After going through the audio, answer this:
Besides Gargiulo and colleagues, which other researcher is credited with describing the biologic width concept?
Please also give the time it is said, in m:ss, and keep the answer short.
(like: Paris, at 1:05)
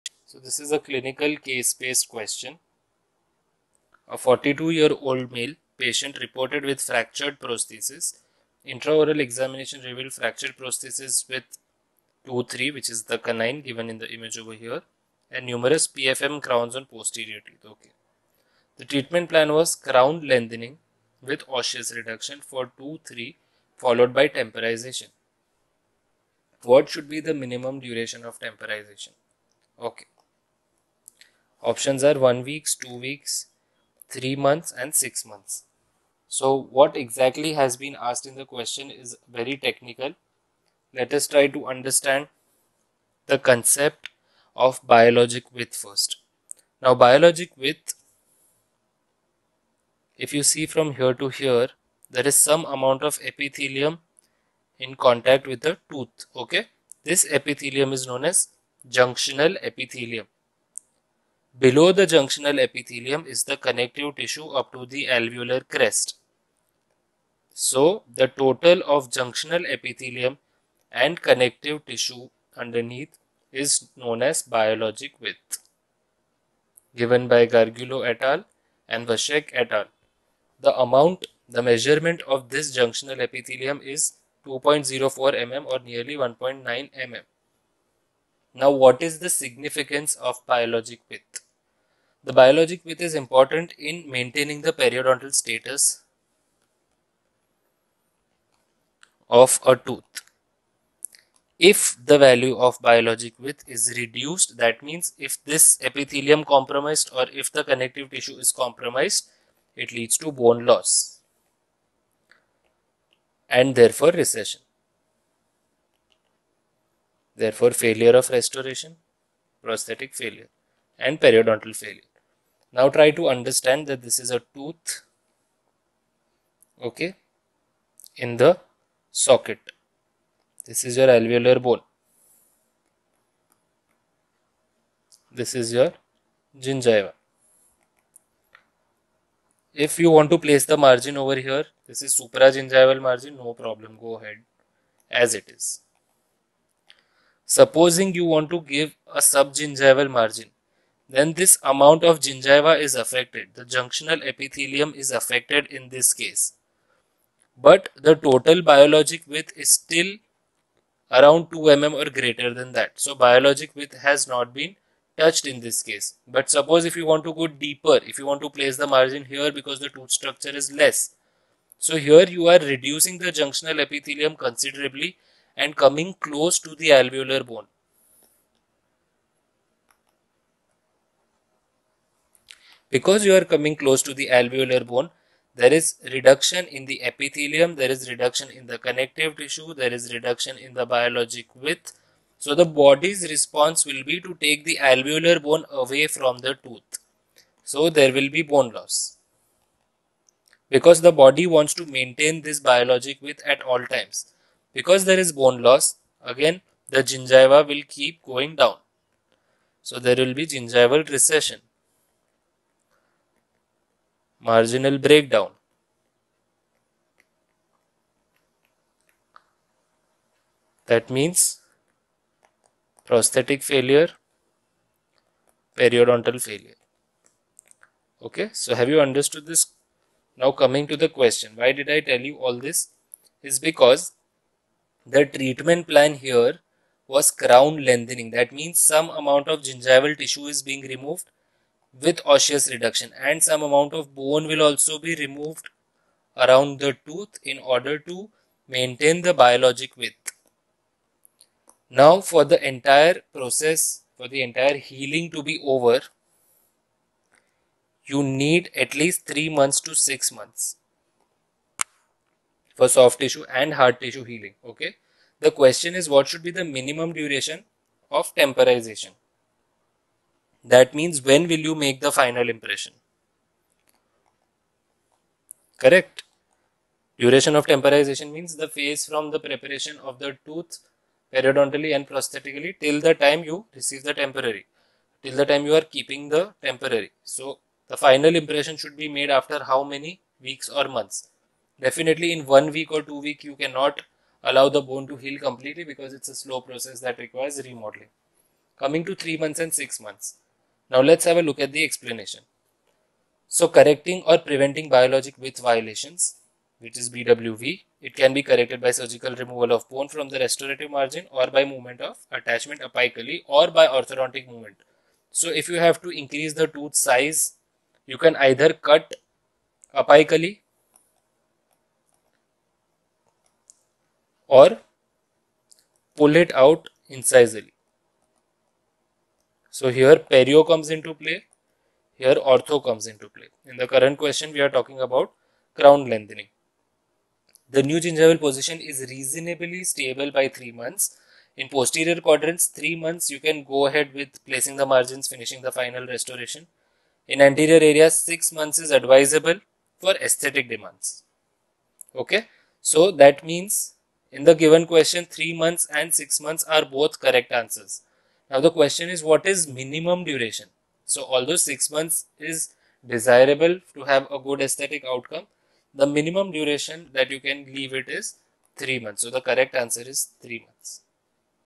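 Vacek, at 1:19.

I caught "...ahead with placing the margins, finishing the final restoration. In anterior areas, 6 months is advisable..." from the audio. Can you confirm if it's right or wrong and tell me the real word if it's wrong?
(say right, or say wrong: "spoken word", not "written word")
right.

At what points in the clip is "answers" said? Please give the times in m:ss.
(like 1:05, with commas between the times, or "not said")
5:57, 6:09.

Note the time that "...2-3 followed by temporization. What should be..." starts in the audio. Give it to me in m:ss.
0:22.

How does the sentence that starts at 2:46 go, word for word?
But suppose if you want to go deeper, if you want to place the margin here because the tooth structure is less.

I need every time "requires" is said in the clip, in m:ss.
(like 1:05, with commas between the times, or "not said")
4:57.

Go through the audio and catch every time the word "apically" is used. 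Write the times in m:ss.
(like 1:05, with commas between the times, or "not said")
5:12, 5:19.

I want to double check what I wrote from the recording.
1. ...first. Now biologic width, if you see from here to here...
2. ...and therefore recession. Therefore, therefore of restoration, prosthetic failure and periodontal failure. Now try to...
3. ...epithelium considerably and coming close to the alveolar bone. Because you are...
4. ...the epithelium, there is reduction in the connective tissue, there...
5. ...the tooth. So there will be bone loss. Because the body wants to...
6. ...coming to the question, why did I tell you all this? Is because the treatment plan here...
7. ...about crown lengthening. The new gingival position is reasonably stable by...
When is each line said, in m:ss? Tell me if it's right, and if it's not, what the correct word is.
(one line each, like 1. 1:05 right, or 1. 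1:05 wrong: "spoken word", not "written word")
1. 0:45 right
2. 1:53 wrong: "failure", not "therefore"
3. 2:53 right
4. 3:06 right
5. 3:16 right
6. 3:50 right
7. 5:34 right.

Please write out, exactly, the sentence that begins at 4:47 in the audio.
So the final impression should be made after how many weeks or months?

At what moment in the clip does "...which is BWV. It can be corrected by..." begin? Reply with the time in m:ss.
5:06.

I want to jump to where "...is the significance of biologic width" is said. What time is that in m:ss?
1:29.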